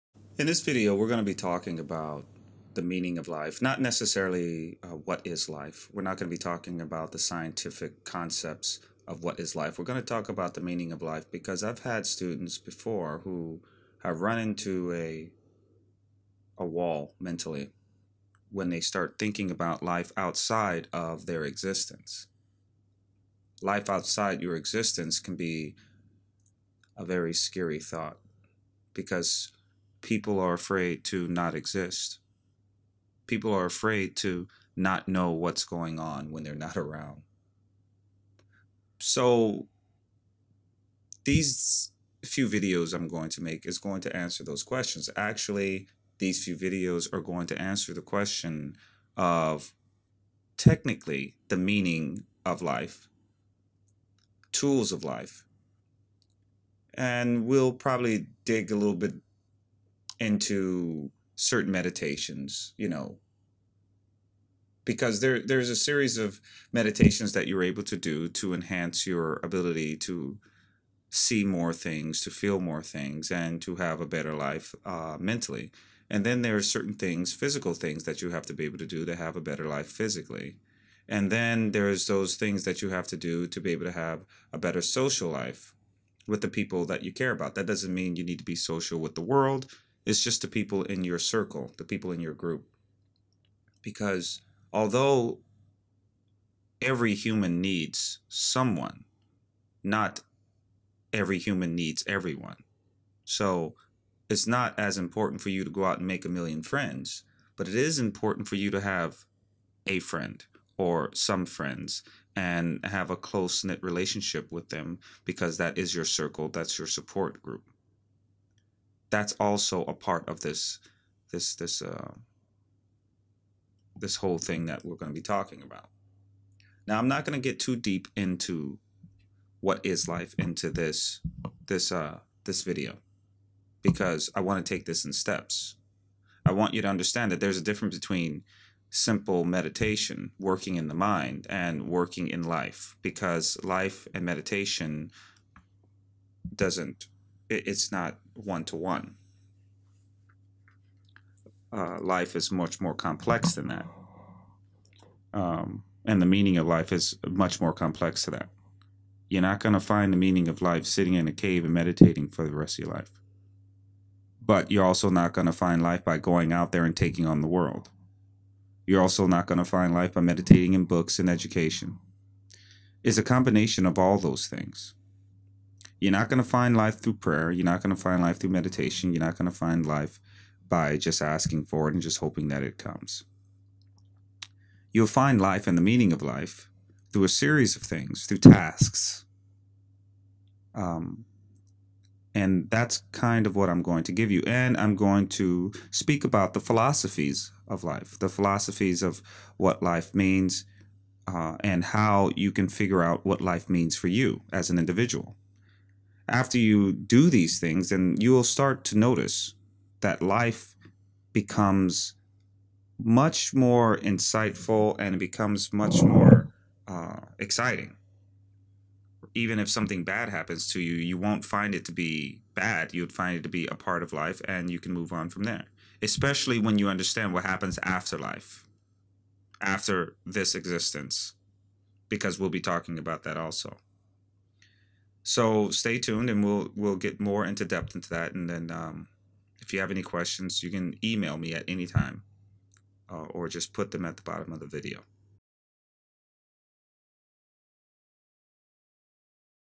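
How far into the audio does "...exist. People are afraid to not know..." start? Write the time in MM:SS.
00:31.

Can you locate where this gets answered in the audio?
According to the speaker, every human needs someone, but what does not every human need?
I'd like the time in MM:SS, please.
01:42.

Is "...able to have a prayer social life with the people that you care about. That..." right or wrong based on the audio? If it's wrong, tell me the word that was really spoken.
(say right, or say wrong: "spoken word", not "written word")
wrong: "better", not "prayer".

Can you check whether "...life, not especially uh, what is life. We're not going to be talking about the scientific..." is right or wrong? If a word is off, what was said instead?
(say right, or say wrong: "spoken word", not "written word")
wrong: "necessarily", not "especially".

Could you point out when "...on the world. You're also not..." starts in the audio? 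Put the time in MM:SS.
02:47.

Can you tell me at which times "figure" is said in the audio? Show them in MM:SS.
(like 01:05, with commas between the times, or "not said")
03:22.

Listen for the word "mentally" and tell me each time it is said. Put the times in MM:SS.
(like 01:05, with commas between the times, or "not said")
00:17, 01:15.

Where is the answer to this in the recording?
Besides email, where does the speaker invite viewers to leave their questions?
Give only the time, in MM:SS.
04:04.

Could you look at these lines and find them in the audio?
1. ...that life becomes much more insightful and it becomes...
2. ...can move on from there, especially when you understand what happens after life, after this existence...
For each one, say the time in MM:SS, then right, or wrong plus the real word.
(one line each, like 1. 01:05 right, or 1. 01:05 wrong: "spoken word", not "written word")
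1. 03:30 right
2. 03:44 right.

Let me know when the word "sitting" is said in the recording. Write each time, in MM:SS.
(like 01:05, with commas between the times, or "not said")
02:40.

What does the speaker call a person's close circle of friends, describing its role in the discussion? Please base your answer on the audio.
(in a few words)
support group.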